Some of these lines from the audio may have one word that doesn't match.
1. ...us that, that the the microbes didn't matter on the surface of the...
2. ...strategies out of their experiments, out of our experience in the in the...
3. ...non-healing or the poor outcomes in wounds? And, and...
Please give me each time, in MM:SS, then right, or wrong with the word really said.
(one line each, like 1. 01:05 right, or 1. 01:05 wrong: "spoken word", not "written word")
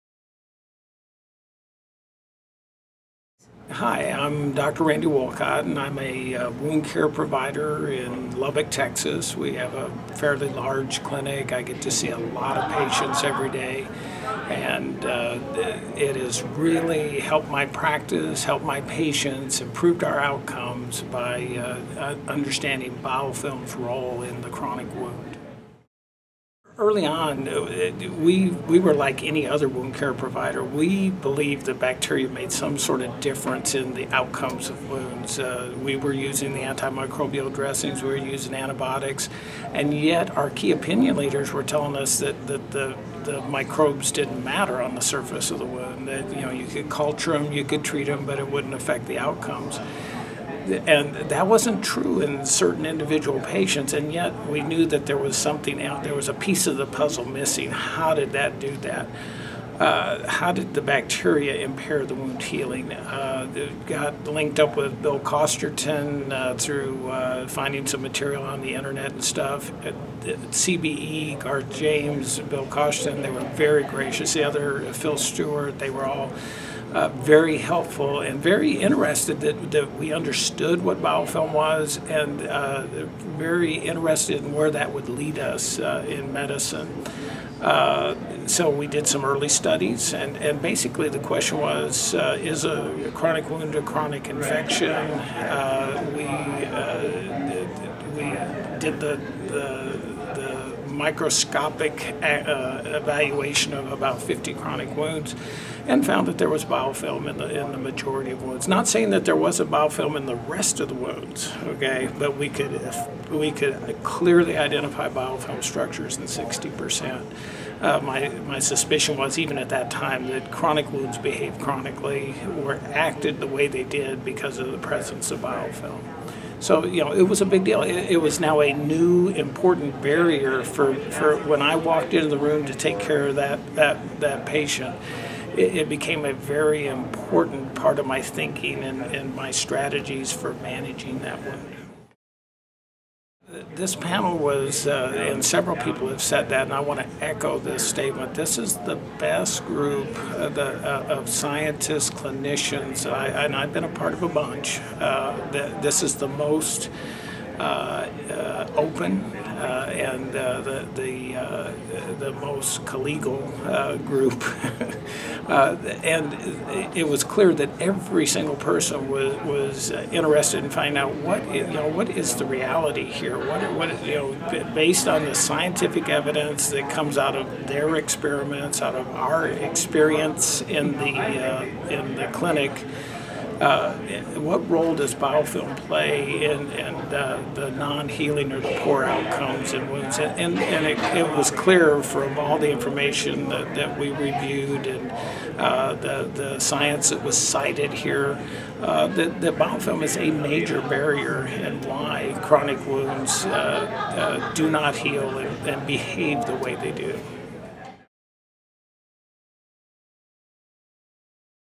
1. 00:41 right
2. 02:56 wrong: "comes", not "strategies"
3. 03:07 right.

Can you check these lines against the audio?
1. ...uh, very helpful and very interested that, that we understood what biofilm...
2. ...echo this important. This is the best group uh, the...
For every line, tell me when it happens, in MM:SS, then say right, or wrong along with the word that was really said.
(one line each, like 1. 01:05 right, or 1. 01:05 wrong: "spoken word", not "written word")
1. 01:16 right
2. 02:27 wrong: "statement", not "important".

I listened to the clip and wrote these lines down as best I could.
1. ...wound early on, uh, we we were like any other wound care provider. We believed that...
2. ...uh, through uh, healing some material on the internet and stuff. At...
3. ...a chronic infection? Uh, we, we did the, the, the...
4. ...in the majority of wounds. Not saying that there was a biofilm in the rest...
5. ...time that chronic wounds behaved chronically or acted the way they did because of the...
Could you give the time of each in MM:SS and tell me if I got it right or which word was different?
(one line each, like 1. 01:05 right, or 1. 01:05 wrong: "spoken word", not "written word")
1. 00:24 right
2. 01:06 wrong: "finding", not "healing"
3. 01:33 right
4. 01:47 right
5. 01:59 right.